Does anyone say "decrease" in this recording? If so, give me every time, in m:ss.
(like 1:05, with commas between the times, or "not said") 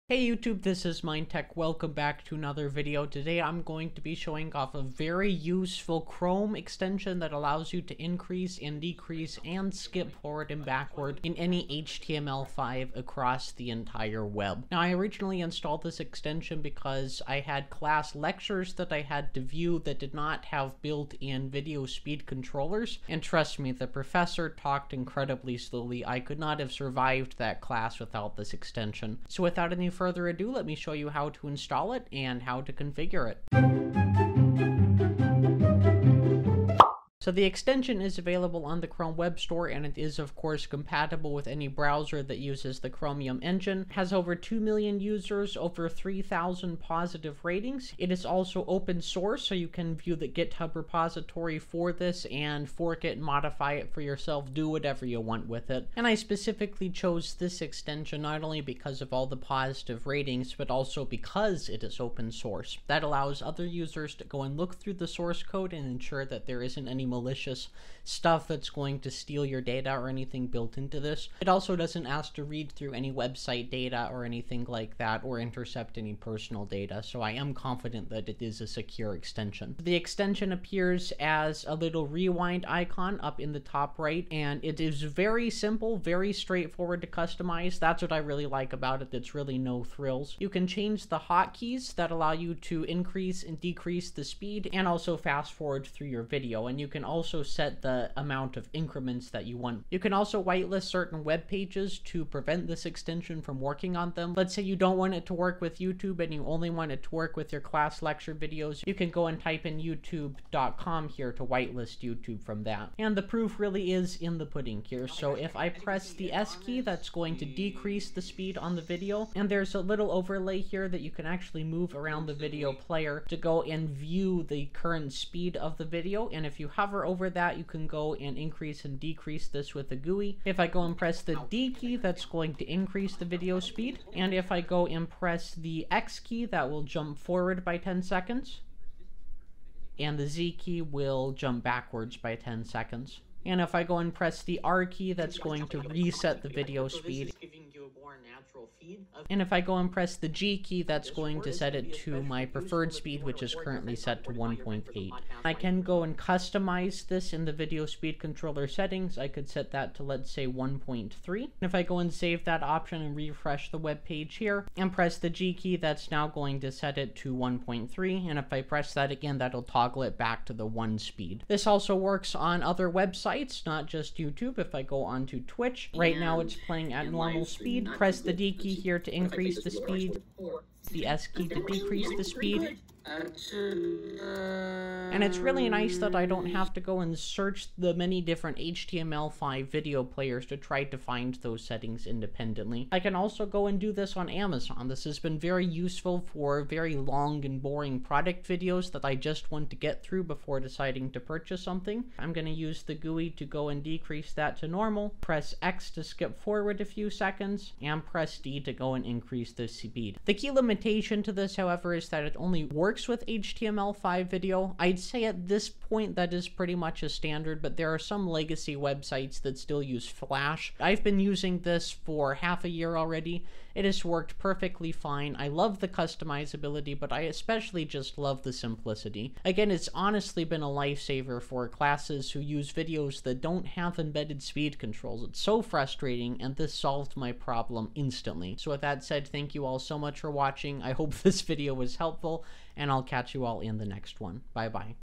0:08, 1:33, 1:57, 2:08, 3:01, 3:23.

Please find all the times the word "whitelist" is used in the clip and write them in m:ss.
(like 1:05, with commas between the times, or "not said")
1:40, 1:51.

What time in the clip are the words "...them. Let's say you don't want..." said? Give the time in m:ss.
1:44.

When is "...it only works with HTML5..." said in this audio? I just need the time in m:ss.
3:32.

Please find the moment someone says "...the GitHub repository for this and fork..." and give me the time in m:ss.
0:50.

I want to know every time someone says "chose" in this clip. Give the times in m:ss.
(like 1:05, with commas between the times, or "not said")
0:56.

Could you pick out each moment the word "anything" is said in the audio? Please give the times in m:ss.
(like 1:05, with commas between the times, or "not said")
1:10, 1:14.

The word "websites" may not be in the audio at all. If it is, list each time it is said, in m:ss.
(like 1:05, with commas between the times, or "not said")
1:13, 2:52, 3:38.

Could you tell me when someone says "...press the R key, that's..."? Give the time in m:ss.
2:24.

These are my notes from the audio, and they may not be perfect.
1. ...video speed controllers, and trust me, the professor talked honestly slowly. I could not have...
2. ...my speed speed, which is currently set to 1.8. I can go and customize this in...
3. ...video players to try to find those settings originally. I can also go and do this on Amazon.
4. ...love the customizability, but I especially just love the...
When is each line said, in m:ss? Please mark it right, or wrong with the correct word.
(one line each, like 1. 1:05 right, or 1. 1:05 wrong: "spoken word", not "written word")
1. 0:21 wrong: "incredibly", not "honestly"
2. 2:32 wrong: "preferred", not "speed"
3. 3:09 wrong: "independently", not "originally"
4. 3:45 right.